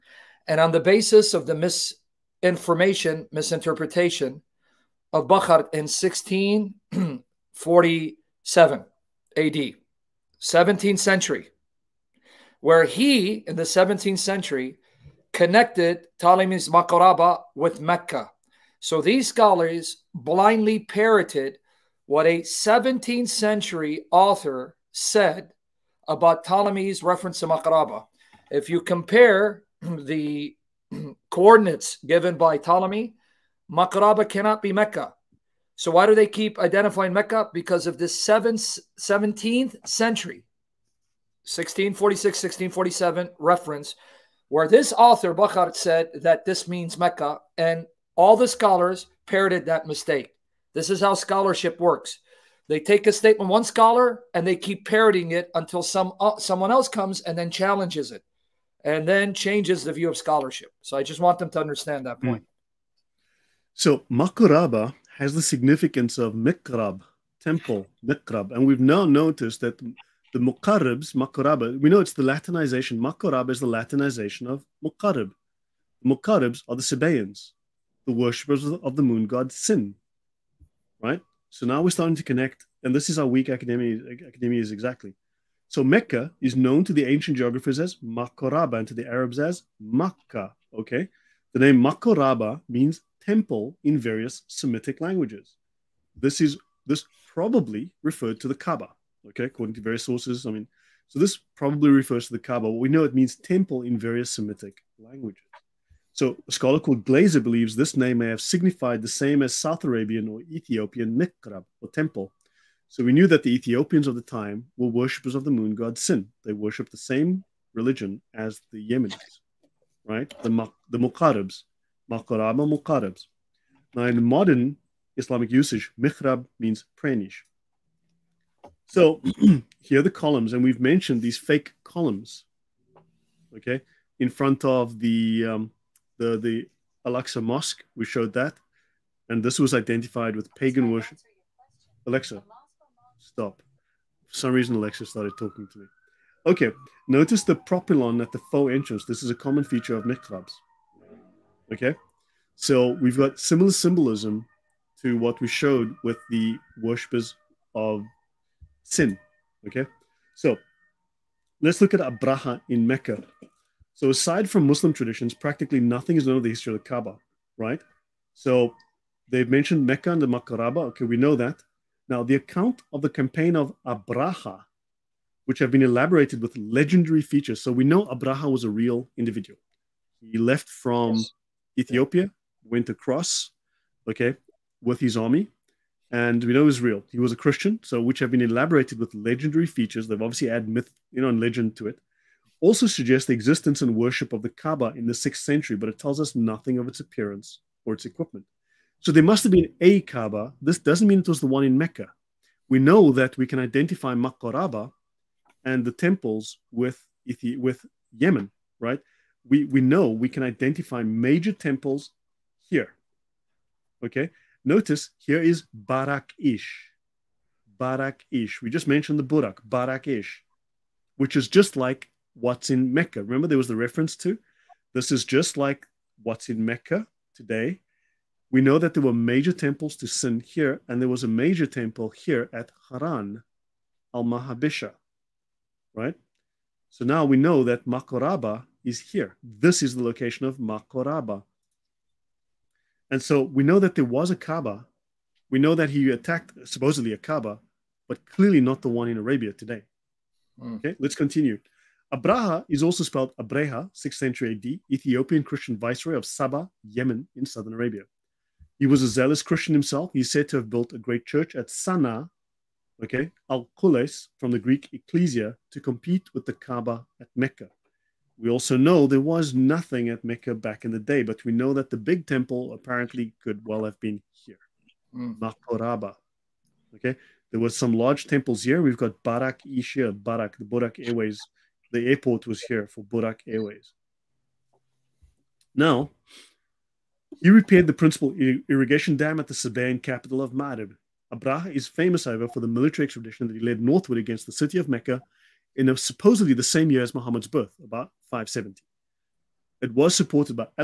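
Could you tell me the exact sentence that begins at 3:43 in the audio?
Remember there was the reference to?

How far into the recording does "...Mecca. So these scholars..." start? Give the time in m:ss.
0:17.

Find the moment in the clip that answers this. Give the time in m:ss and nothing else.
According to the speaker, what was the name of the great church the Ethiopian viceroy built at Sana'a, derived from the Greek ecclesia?
4:23.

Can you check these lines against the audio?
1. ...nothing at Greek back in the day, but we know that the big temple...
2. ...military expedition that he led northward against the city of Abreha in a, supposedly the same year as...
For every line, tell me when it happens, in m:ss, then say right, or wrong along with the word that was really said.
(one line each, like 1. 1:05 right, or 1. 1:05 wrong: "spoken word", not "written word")
1. 4:29 wrong: "Mecca", not "Greek"
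2. 4:52 wrong: "Mecca", not "Abreha".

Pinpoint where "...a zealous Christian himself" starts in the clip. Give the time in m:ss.
4:19.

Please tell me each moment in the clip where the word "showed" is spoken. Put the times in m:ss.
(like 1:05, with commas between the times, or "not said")
2:18, 2:35.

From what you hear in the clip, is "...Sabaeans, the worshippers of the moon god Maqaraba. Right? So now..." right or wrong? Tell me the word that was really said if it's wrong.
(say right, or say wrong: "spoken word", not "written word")
wrong: "Sin", not "Maqaraba".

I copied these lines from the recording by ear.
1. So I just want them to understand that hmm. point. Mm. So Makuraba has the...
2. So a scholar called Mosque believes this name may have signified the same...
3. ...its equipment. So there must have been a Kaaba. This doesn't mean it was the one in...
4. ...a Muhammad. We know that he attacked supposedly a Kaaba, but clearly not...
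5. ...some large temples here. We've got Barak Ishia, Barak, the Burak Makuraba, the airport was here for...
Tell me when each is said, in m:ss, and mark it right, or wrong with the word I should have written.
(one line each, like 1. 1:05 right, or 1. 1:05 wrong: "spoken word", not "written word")
1. 1:00 right
2. 1:46 wrong: "Glaser", not "Mosque"
3. 3:17 right
4. 4:04 wrong: "Kaaba", not "Muhammad"
5. 4:37 wrong: "Airways", not "Makuraba".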